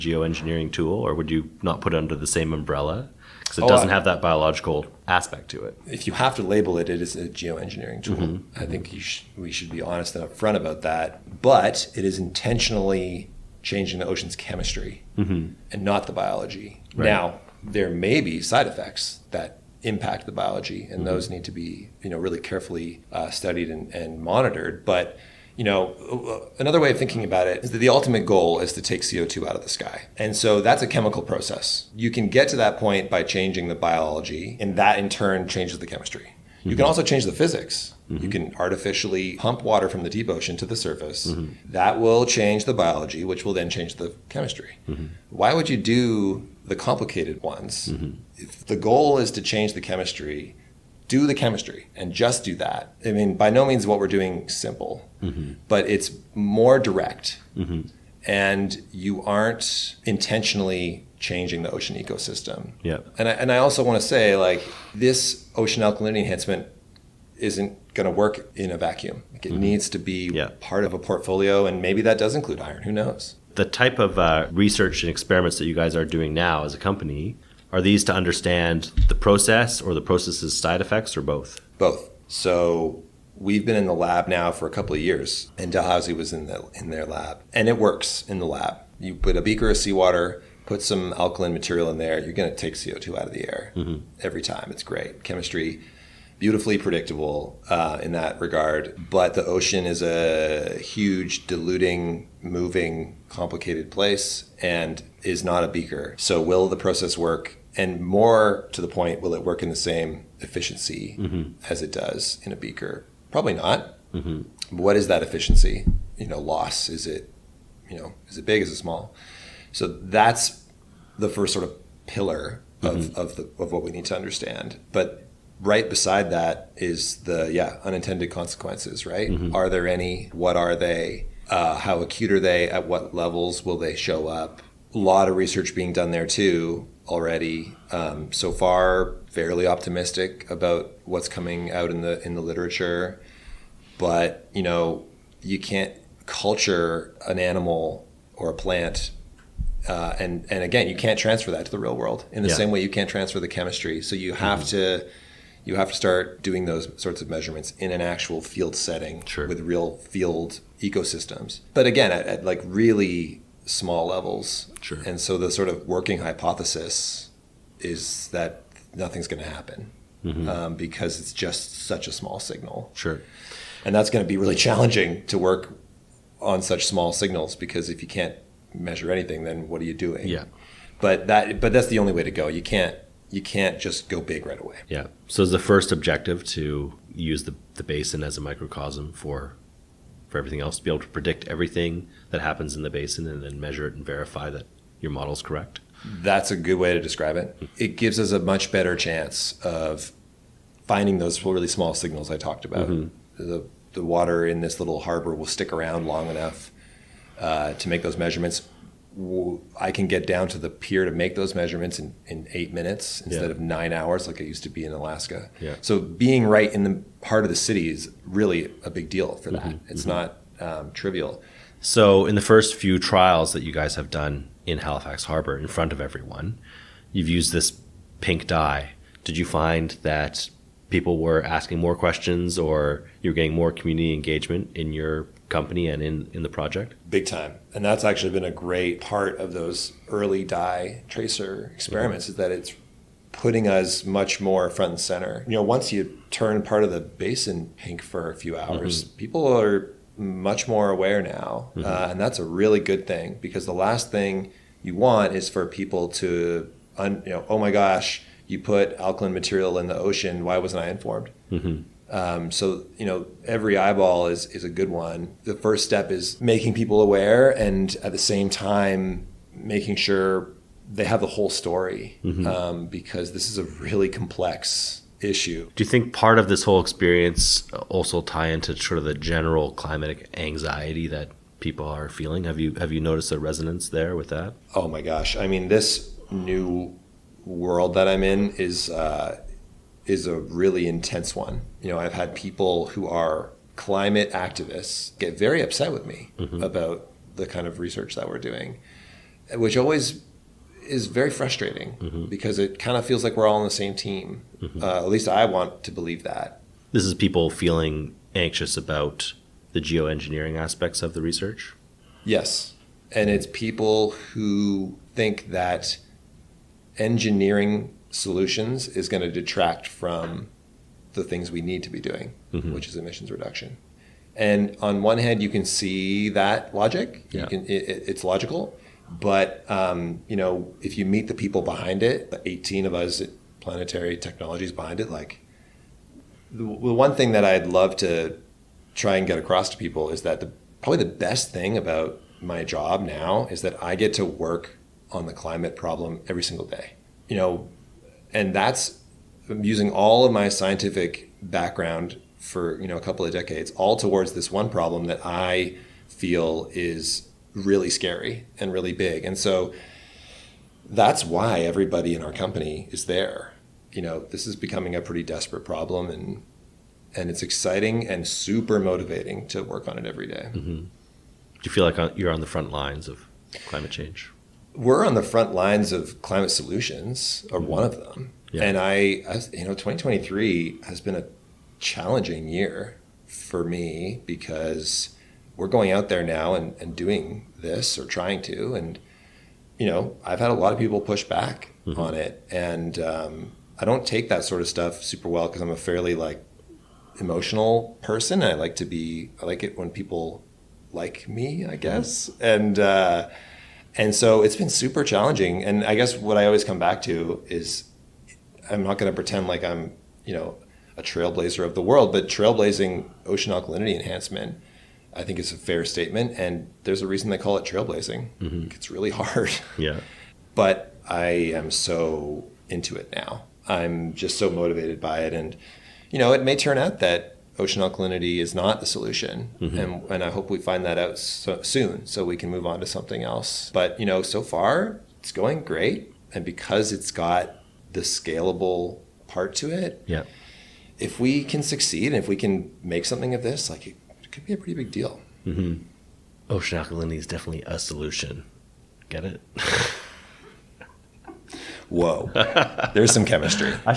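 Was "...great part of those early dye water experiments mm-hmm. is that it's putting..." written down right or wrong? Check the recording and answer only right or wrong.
wrong.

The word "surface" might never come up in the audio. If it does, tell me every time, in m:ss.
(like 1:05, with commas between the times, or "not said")
0:40.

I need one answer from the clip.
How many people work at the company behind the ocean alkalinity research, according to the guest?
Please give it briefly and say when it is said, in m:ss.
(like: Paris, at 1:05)
18, at 5:32.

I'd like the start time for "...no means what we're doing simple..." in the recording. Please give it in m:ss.
0:53.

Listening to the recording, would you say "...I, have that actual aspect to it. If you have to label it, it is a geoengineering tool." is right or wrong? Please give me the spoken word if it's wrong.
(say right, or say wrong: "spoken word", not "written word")
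wrong: "biological", not "actual".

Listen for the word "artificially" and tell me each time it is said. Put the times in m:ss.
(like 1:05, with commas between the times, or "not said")
0:38.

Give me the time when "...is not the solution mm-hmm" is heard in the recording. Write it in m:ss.
7:08.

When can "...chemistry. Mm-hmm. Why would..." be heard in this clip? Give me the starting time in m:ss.
0:44.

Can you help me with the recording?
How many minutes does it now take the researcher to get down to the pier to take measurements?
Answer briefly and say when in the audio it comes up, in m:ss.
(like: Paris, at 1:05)
8, at 3:32.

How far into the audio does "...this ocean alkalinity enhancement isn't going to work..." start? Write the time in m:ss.
1:04.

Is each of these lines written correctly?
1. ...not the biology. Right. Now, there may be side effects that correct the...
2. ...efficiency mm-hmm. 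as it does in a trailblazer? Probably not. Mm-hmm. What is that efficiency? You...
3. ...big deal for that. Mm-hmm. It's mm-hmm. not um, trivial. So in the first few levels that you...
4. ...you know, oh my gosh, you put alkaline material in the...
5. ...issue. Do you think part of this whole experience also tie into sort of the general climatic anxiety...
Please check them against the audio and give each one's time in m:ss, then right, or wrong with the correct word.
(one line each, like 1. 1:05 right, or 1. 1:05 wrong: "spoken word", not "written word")
1. 0:15 wrong: "impact", not "correct"
2. 1:50 wrong: "beaker", not "trailblazer"
3. 3:38 wrong: "trials", not "levels"
4. 4:17 right
5. 4:35 right.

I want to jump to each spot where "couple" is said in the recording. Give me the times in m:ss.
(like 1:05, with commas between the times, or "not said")
1:24, 5:53.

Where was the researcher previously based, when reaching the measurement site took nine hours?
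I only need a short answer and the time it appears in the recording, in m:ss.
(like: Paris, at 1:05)
Alaska, at 3:34.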